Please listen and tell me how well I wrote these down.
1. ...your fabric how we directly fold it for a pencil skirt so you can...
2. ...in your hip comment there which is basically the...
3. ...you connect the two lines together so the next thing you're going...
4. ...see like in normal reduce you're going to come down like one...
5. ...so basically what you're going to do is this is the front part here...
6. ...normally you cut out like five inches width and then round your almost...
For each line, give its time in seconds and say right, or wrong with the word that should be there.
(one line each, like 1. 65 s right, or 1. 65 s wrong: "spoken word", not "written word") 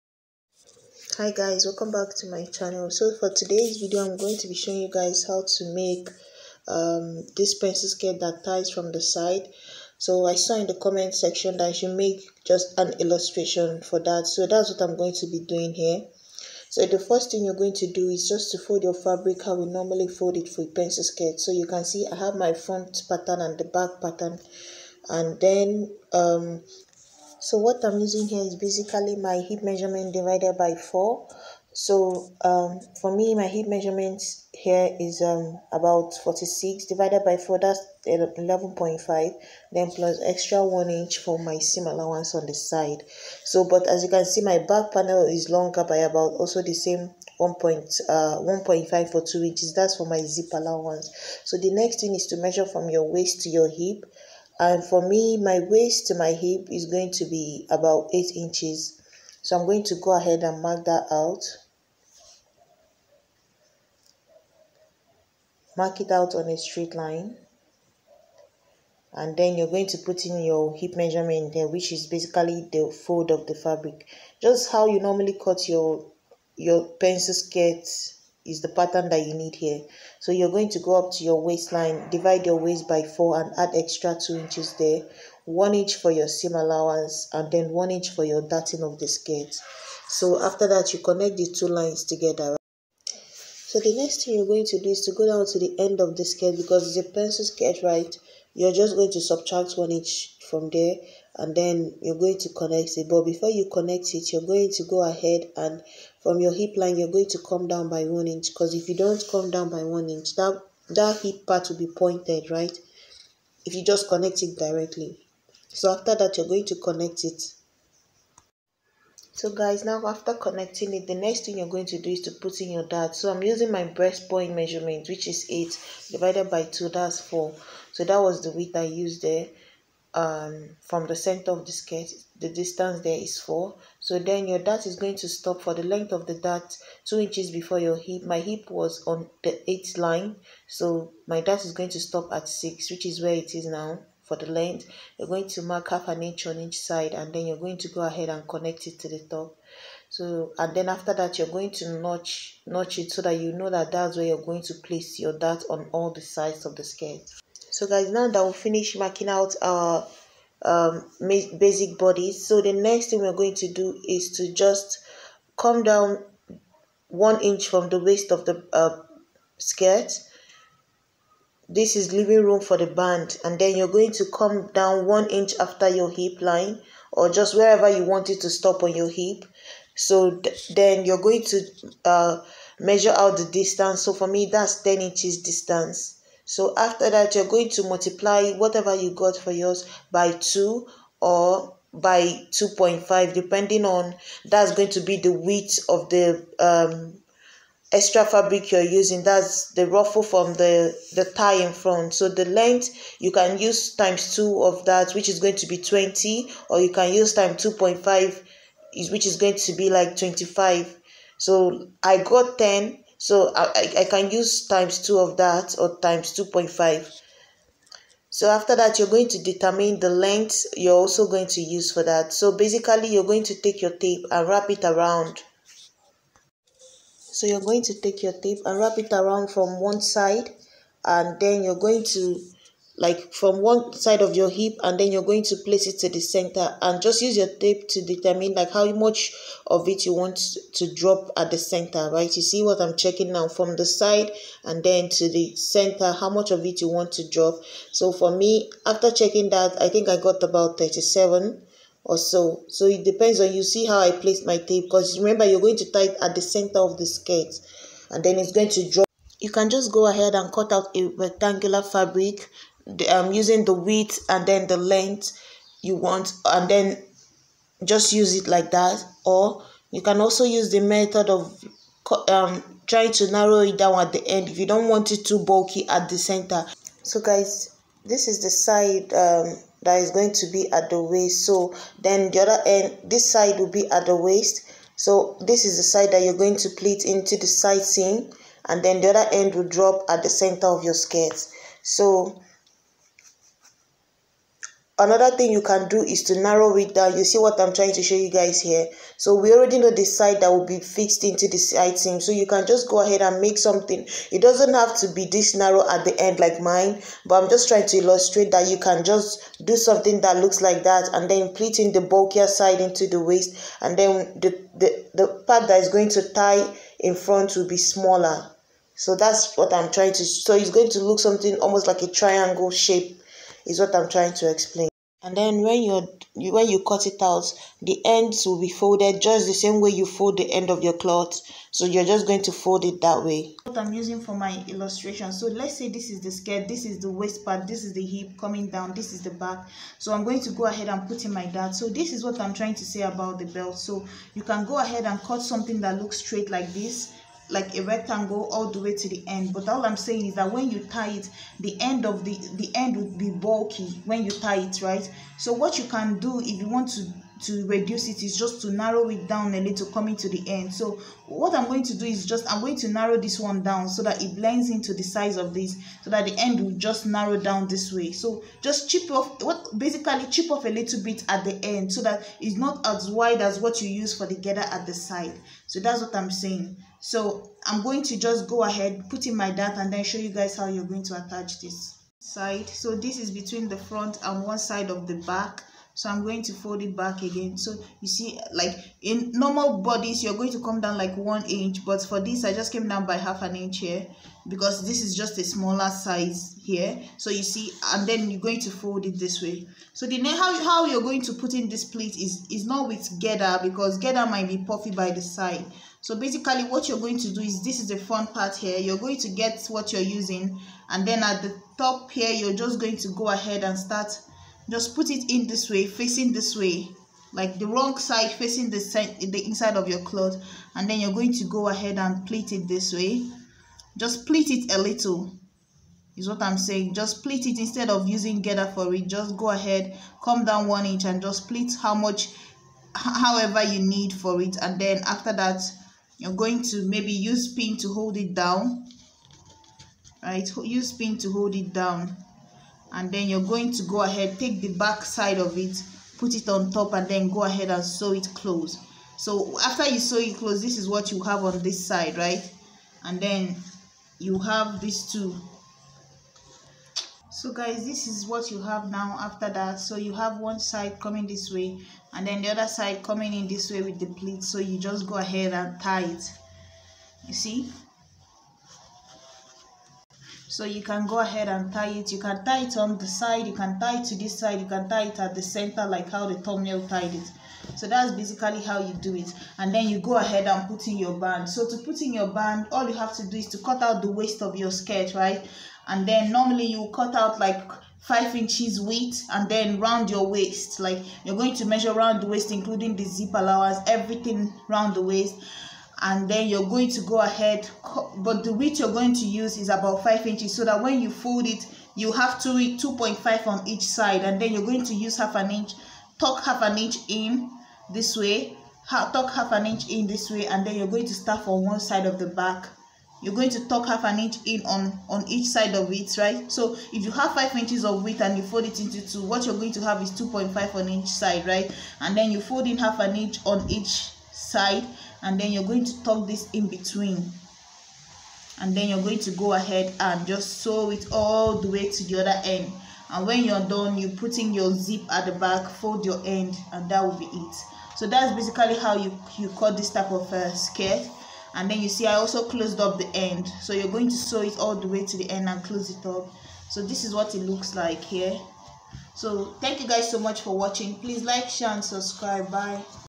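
1. 18 s wrong: "normally", not "directly"
2. 70 s wrong: "measurement", not "comment"
3. 90 s right
4. 388 s wrong: "bodice", not "reduce"
5. 406 s right
6. 486 s wrong: "waist", not "almost".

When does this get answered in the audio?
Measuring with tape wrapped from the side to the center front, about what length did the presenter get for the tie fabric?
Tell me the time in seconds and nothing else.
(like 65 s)
250 s.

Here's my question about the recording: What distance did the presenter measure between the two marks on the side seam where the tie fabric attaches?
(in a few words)
10 inches.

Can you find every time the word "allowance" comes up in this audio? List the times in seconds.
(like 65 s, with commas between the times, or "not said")
41 s, 50 s, 86 s, 493 s.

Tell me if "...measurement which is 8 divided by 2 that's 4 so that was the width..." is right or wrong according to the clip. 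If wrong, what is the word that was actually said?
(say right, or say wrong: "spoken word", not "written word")
right.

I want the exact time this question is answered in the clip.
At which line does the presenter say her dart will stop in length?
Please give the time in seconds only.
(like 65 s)
141 s.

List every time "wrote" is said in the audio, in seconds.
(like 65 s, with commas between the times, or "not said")
not said.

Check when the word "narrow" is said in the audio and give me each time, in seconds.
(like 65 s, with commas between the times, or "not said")
273 s, 296 s, 305 s, 358 s, 362 s, 367 s.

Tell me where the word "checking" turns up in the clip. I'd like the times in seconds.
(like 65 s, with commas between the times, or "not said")
242 s, 249 s.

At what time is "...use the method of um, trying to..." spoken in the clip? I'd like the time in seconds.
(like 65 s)
270 s.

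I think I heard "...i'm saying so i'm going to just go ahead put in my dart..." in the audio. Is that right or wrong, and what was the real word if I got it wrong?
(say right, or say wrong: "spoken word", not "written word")
right.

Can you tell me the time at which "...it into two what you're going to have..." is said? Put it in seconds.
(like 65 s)
518 s.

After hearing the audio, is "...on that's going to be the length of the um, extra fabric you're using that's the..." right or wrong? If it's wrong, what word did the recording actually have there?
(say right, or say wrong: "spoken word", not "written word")
wrong: "width", not "length".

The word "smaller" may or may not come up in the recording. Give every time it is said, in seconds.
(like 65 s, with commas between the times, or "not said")
317 s, 395 s.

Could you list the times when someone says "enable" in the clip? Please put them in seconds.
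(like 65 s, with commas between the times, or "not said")
not said.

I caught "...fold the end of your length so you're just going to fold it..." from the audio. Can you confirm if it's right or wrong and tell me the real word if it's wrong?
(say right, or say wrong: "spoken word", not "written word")
wrong: "cloth", not "length".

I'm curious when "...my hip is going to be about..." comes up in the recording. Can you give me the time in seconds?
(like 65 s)
56 s.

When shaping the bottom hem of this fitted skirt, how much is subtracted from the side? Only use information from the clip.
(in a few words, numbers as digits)
1 inch.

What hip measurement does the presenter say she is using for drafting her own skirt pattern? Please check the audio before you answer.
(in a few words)
46.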